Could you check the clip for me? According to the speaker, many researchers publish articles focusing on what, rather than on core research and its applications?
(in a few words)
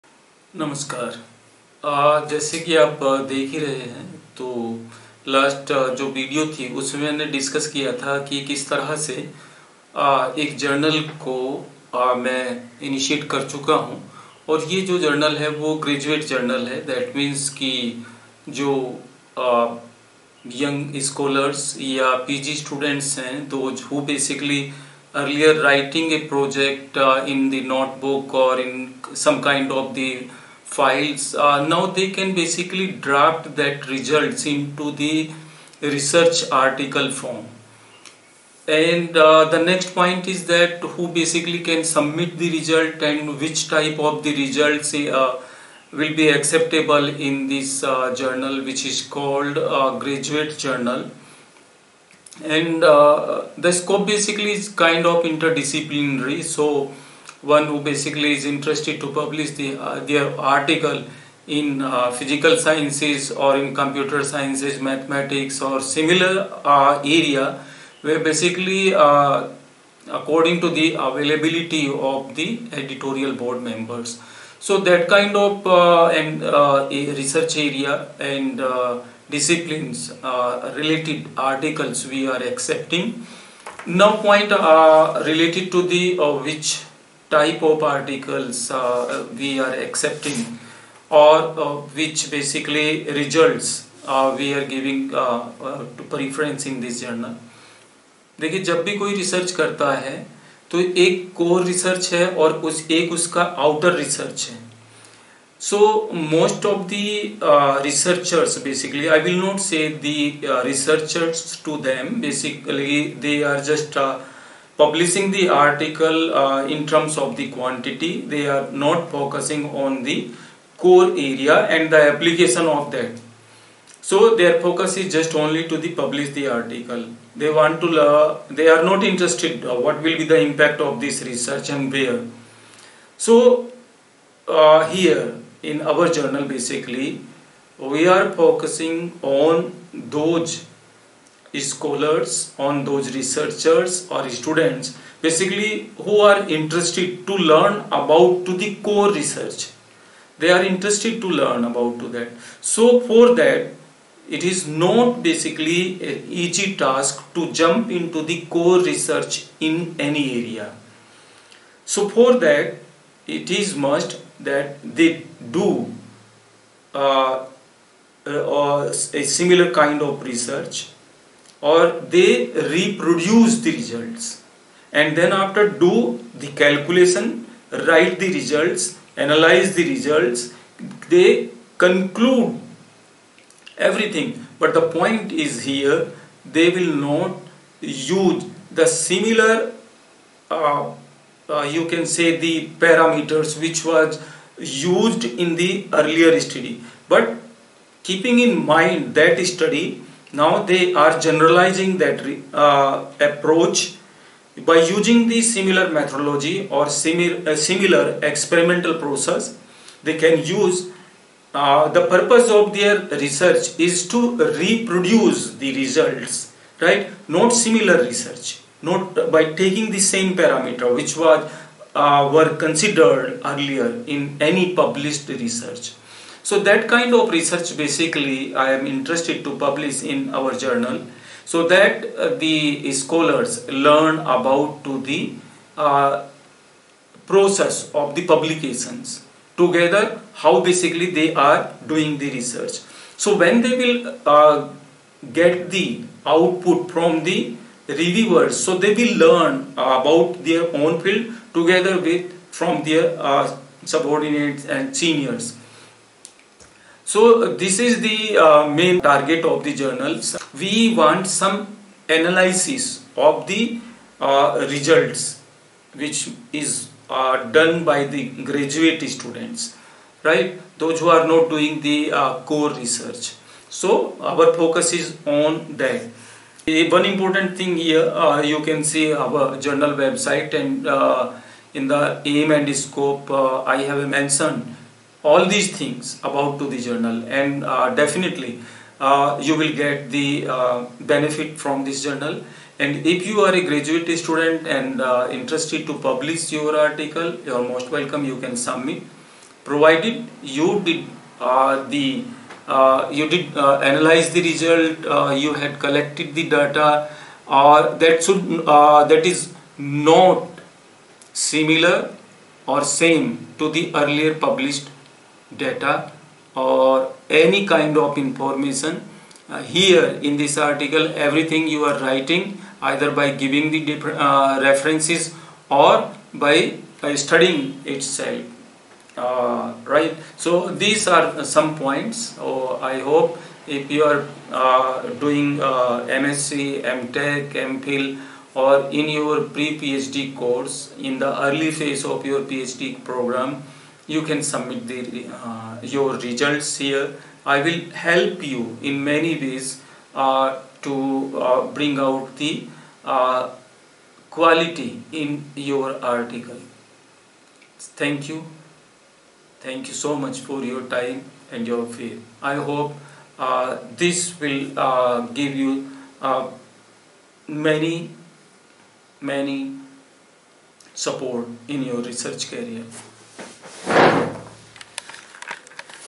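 Quantity.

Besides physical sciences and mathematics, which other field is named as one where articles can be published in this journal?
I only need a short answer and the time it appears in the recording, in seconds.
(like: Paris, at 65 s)
Computer sciences, at 63 s.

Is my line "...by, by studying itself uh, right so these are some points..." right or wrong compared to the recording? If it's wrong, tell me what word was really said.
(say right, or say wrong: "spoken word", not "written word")
right.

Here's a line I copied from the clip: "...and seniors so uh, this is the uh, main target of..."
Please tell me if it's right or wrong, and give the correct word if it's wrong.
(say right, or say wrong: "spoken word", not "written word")
right.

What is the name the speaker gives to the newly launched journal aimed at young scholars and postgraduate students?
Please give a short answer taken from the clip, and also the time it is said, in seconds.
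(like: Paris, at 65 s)
Graduate journal, at 49 s.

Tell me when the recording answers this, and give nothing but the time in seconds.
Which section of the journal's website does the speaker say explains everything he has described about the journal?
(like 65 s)
282 s.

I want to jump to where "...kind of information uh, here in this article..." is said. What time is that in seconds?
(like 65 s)
317 s.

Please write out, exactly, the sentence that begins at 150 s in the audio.
They are interested to learn about to that.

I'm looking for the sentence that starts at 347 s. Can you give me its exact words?
I will help you in many ways uh, to uh, bring out the uh, quality in your article.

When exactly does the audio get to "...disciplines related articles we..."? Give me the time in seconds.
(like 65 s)
79 s.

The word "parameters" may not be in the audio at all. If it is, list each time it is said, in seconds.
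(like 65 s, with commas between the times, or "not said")
192 s, 220 s.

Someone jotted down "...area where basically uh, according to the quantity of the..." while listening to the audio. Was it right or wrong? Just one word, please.
wrong.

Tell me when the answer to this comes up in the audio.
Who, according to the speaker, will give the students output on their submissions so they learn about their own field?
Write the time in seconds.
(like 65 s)
247 s.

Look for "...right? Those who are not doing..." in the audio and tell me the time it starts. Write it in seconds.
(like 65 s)
270 s.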